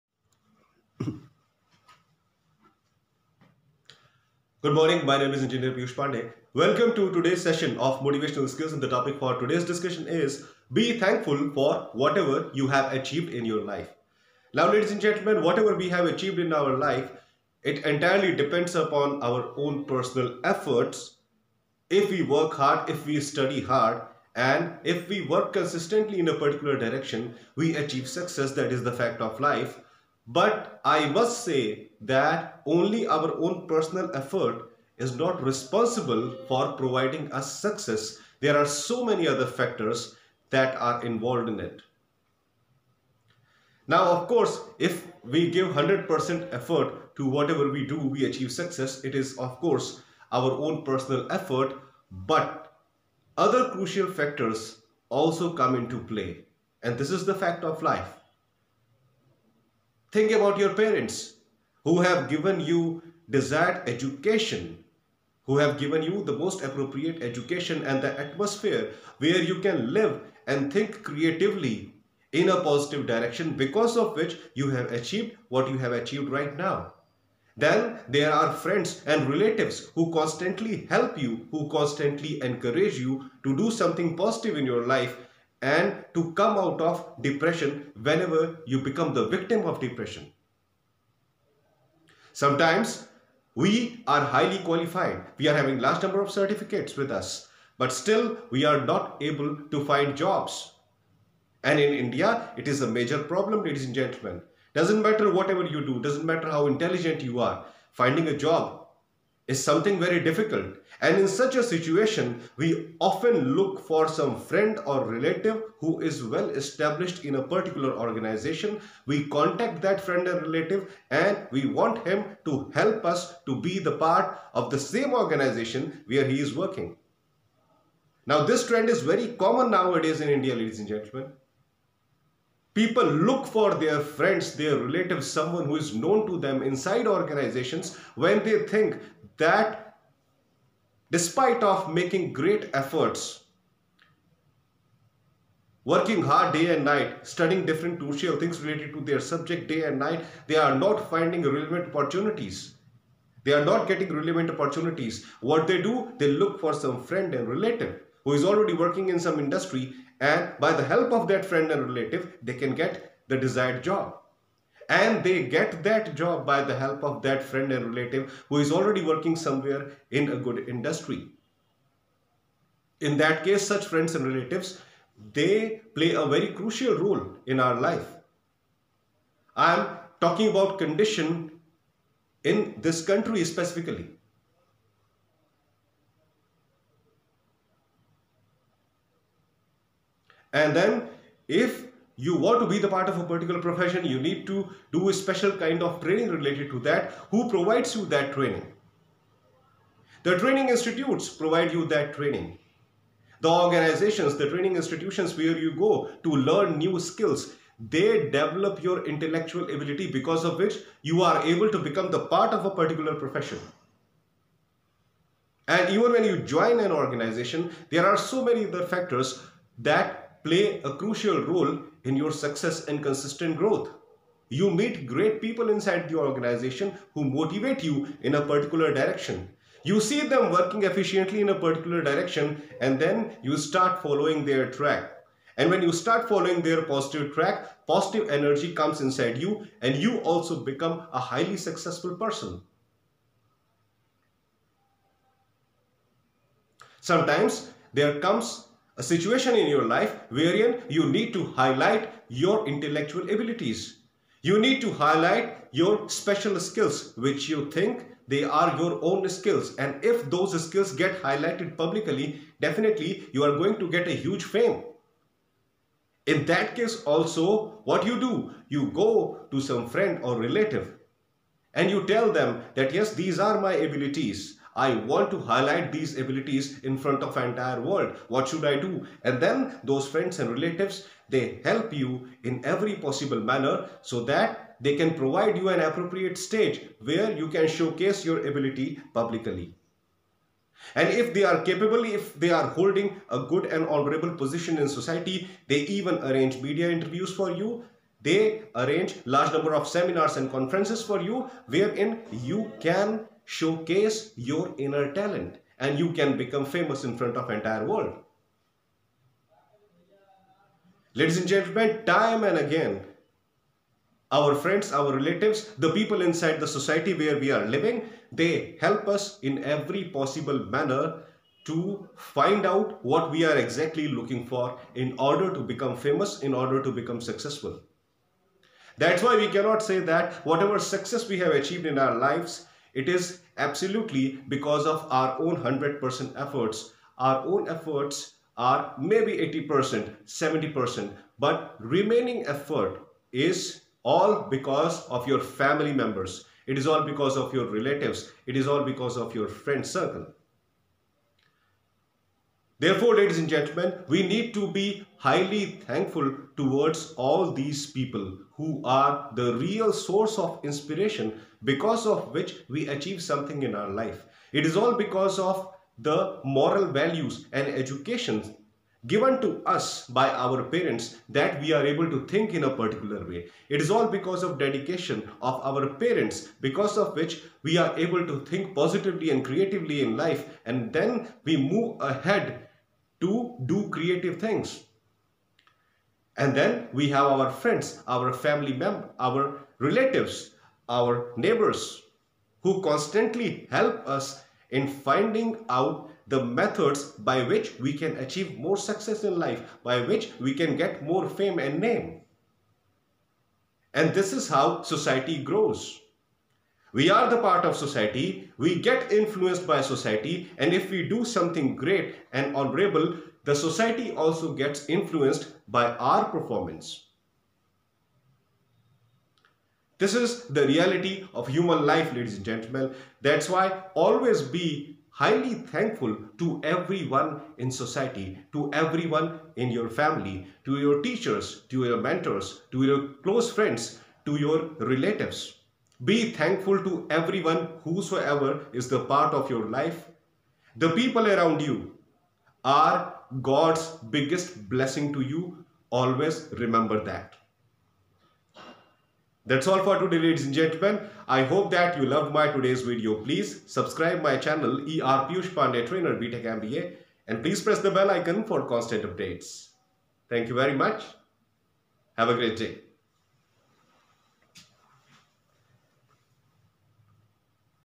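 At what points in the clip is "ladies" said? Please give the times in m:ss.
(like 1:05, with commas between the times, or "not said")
0:14, 1:43, 2:10, 5:11, 5:53, 7:02, 7:30.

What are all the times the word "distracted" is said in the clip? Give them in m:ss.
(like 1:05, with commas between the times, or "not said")
not said.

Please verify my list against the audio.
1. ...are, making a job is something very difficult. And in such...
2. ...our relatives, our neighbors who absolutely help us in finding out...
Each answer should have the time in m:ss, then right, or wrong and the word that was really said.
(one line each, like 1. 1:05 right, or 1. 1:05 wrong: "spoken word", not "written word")
1. 1:47 wrong: "finding", not "making"
2. 6:29 wrong: "constantly", not "absolutely".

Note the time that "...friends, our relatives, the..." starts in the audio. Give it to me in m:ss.
5:14.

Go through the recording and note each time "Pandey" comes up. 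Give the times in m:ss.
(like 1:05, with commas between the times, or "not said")
0:05, 7:35.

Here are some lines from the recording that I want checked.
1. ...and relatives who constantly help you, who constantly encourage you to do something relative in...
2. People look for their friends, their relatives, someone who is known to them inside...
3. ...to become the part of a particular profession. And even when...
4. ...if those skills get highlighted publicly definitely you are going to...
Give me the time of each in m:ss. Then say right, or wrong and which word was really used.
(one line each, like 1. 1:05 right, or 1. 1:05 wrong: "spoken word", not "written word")
1. 1:19 wrong: "positive", not "relative"
2. 2:12 right
3. 3:31 right
4. 4:20 right.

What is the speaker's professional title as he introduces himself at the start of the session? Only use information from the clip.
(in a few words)
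Engineer.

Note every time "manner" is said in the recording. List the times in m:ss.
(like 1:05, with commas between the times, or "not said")
4:43, 5:20.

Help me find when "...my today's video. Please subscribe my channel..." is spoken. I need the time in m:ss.
7:32.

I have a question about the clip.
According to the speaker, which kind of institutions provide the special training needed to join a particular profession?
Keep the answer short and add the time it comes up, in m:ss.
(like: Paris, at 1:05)
training institutes, at 3:20.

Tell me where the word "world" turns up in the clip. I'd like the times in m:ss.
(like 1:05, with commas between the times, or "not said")
4:37, 5:07.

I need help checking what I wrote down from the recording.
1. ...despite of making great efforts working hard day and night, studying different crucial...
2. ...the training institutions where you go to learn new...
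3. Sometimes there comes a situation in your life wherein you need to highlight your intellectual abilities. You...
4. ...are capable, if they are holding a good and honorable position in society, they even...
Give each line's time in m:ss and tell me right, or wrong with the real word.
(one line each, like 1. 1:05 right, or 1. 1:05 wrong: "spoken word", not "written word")
1. 2:21 right
2. 3:24 right
3. 4:07 right
4. 4:51 right.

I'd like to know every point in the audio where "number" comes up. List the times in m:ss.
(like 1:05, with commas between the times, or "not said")
1:36, 4:59.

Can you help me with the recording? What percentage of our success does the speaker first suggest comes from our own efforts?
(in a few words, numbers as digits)
80%.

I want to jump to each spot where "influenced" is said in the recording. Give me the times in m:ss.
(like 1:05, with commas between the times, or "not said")
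6:49, 6:54.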